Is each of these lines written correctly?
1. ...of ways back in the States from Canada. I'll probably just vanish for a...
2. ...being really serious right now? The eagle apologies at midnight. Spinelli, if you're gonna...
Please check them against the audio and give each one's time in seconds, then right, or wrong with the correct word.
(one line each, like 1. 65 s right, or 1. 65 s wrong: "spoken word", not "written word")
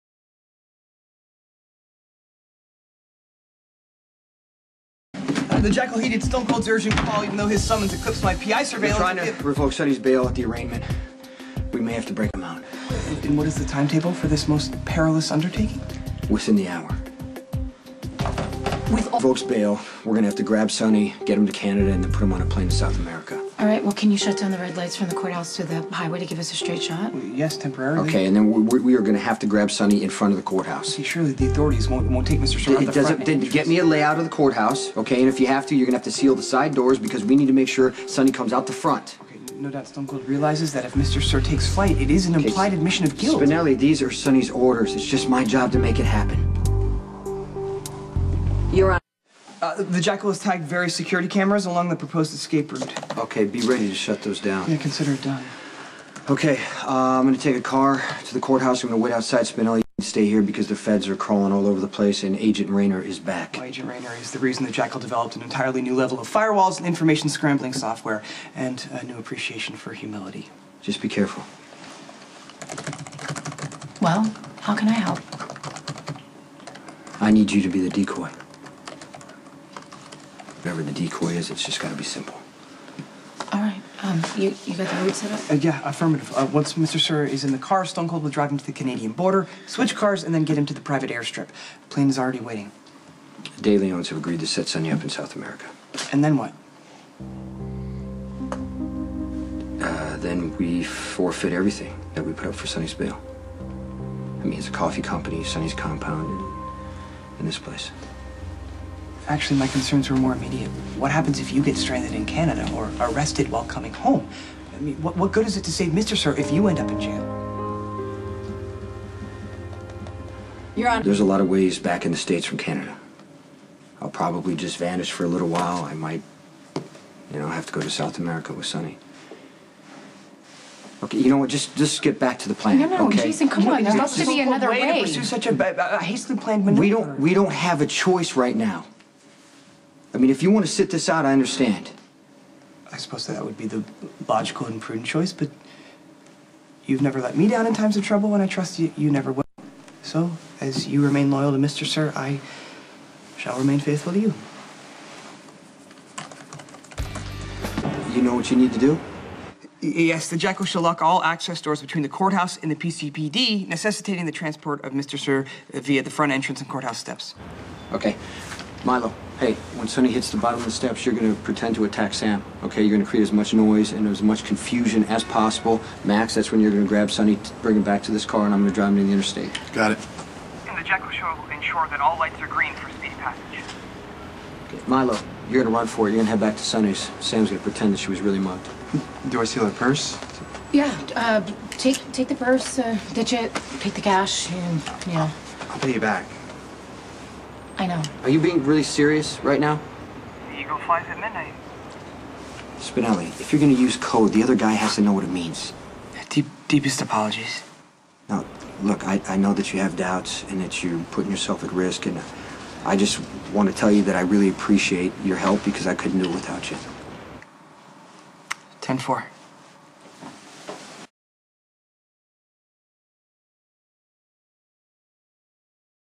1. 121 s right
2. 198 s wrong: "flies", not "apologies".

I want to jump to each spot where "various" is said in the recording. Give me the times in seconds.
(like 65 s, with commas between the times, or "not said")
50 s.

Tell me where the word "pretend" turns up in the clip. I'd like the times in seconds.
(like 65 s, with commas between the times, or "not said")
171 s, 187 s.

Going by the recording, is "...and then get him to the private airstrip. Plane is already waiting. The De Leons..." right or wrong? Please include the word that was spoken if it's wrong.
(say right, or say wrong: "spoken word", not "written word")
right.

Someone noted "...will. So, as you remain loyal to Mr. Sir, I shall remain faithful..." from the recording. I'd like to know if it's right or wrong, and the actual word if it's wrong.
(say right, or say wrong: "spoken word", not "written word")
right.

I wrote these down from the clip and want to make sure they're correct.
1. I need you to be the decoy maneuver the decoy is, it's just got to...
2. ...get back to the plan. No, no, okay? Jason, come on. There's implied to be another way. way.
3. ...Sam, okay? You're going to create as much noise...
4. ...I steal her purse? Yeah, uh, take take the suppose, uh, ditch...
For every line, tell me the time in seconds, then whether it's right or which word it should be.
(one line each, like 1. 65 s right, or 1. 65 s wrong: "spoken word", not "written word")
1. 77 s wrong: "whatever", not "maneuver"
2. 132 s wrong: "supposed", not "implied"
3. 172 s right
4. 189 s wrong: "purse", not "suppose".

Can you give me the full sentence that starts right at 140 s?
I mean, if you want to sit this out, I understand.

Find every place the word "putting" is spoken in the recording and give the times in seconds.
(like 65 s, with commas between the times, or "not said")
211 s.